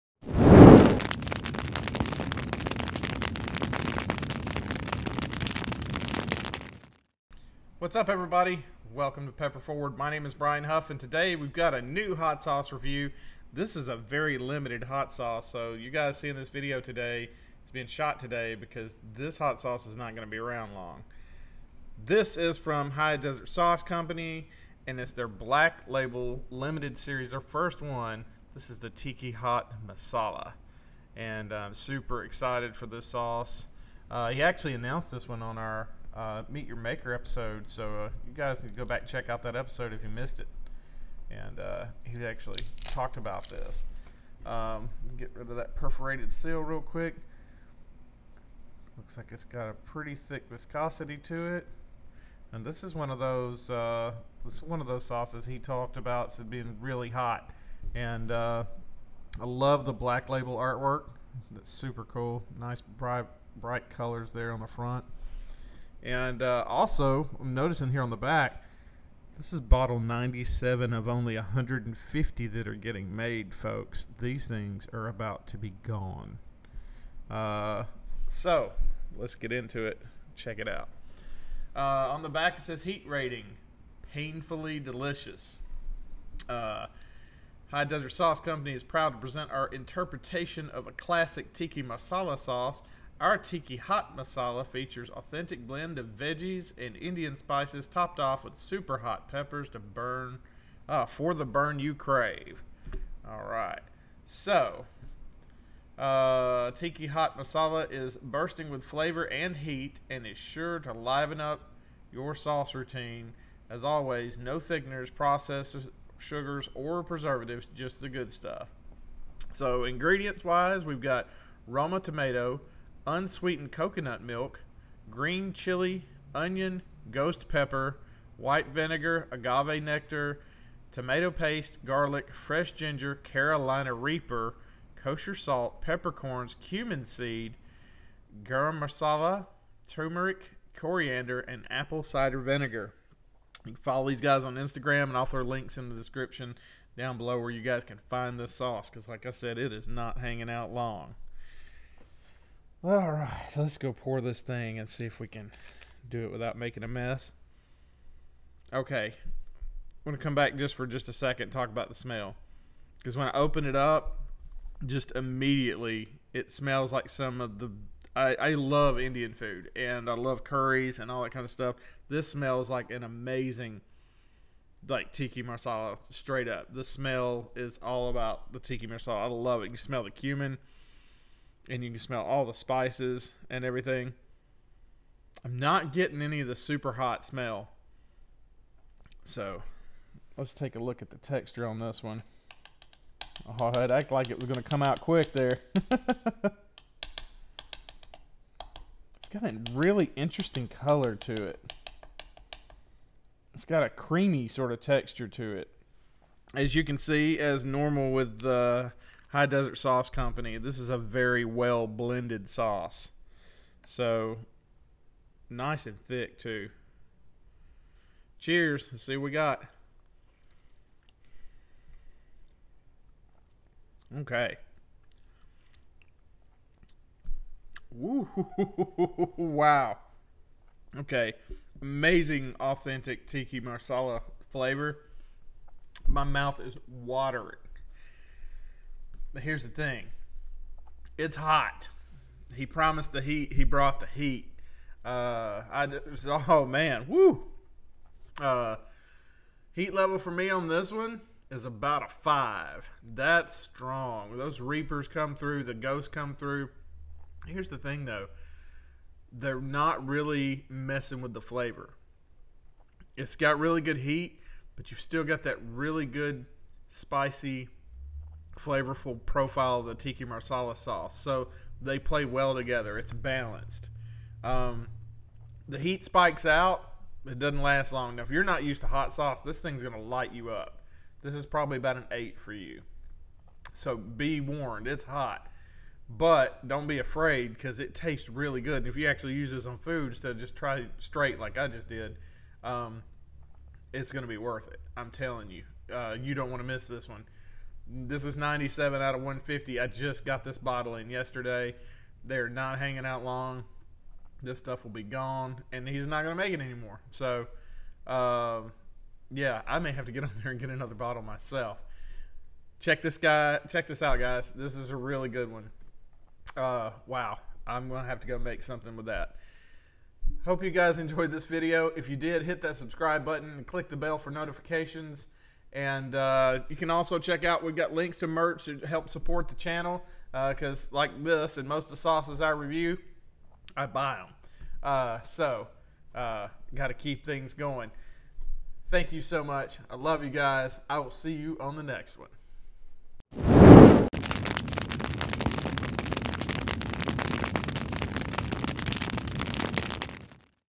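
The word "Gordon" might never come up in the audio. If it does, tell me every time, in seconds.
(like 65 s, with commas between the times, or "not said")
not said.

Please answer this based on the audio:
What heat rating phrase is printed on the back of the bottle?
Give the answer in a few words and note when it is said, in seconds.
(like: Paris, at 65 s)
Painfully delicious, at 84 s.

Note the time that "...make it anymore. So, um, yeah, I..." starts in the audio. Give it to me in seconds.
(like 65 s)
306 s.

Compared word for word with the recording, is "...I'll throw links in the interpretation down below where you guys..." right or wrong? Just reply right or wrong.
wrong.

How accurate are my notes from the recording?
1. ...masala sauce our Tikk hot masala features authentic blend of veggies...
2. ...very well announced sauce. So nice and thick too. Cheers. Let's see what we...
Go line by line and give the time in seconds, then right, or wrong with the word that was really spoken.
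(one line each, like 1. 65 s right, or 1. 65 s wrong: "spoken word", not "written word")
1. 91 s right
2. 210 s wrong: "blended", not "announced".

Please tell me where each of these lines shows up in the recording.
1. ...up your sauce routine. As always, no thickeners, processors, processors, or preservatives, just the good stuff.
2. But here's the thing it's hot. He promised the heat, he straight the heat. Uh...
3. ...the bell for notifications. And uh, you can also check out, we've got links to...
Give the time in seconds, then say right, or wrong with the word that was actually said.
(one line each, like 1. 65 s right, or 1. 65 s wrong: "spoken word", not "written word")
1. 111 s wrong: "sugars", not "processors"
2. 239 s wrong: "brought", not "straight"
3. 323 s right.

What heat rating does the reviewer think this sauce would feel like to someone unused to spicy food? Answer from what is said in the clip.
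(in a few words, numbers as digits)
8.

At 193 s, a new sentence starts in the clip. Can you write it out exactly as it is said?
Oh, i act like it was going to come out quick there.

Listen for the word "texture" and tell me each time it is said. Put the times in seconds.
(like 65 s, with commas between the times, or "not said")
191 s, 204 s.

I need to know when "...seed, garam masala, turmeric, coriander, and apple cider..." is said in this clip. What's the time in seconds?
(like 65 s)
137 s.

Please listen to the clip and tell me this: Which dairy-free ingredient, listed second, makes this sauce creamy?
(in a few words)
Unsweetened coconut milk.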